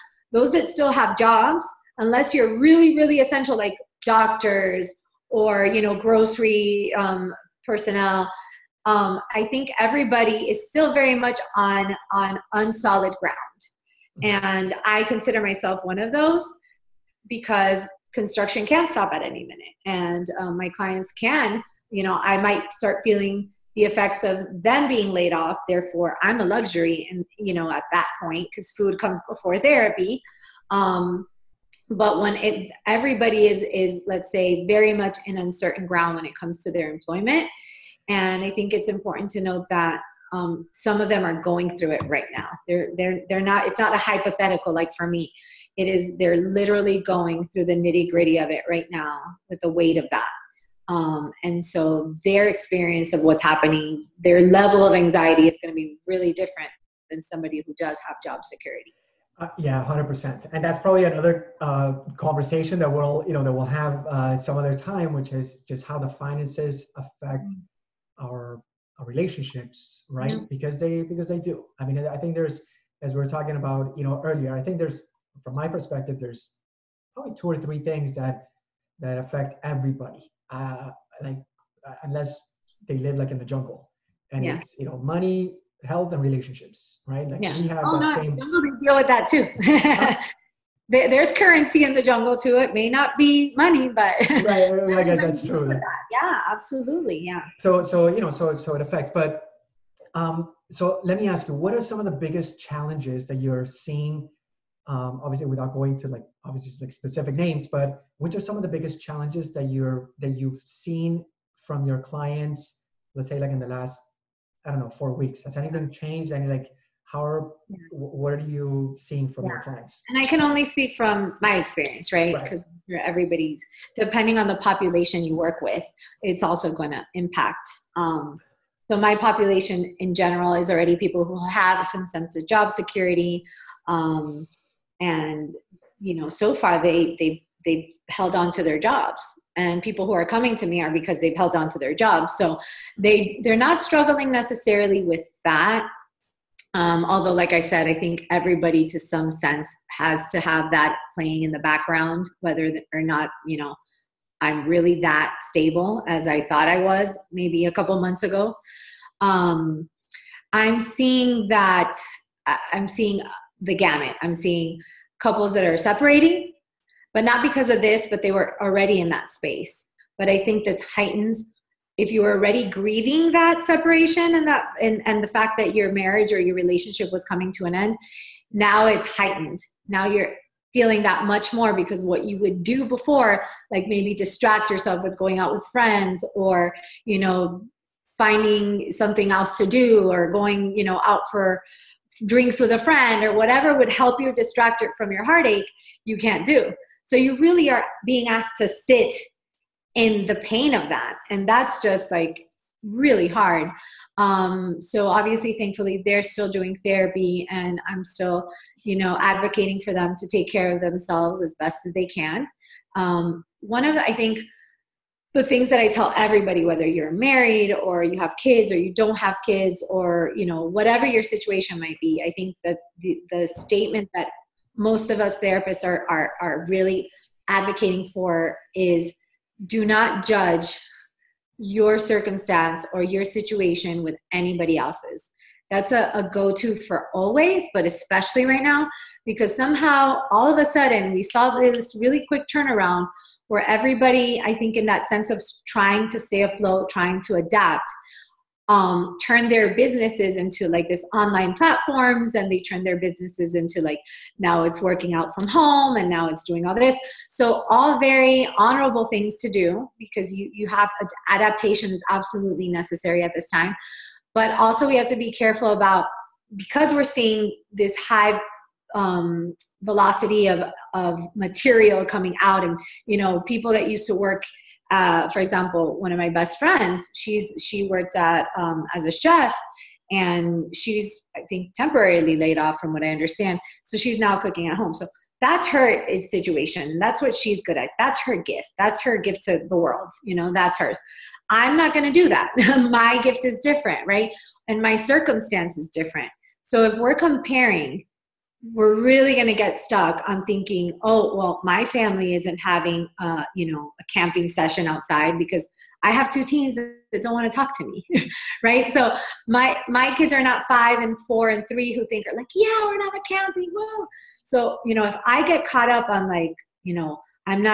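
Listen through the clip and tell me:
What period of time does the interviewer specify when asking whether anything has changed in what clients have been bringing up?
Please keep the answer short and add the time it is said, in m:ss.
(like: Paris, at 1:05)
four weeks, at 1:54.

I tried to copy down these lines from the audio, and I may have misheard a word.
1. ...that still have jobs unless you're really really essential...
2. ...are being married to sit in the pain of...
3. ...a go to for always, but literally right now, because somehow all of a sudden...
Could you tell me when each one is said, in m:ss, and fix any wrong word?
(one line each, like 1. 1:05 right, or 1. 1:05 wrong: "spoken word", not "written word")
1. 0:00 right
2. 3:17 wrong: "asked", not "married"
3. 3:56 wrong: "especially", not "literally".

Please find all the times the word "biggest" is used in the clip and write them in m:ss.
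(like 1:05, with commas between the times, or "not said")
1:42, 1:48.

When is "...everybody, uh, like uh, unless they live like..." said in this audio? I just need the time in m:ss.
1:19.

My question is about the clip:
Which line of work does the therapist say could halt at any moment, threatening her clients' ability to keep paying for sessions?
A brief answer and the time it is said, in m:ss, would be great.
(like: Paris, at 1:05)
construction, at 0:18.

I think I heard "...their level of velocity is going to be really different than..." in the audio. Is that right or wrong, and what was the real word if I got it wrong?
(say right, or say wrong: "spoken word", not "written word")
wrong: "anxiety", not "velocity".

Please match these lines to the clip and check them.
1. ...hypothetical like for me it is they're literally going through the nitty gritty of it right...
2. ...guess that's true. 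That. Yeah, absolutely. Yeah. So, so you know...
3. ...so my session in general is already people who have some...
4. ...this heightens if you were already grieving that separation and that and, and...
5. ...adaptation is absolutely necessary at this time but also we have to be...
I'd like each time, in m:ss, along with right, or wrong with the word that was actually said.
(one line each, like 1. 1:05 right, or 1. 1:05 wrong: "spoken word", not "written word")
1. 0:43 right
2. 1:35 right
3. 2:08 wrong: "population", not "session"
4. 2:50 right
5. 4:21 right.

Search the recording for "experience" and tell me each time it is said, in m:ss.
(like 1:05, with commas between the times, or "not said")
0:52, 2:01.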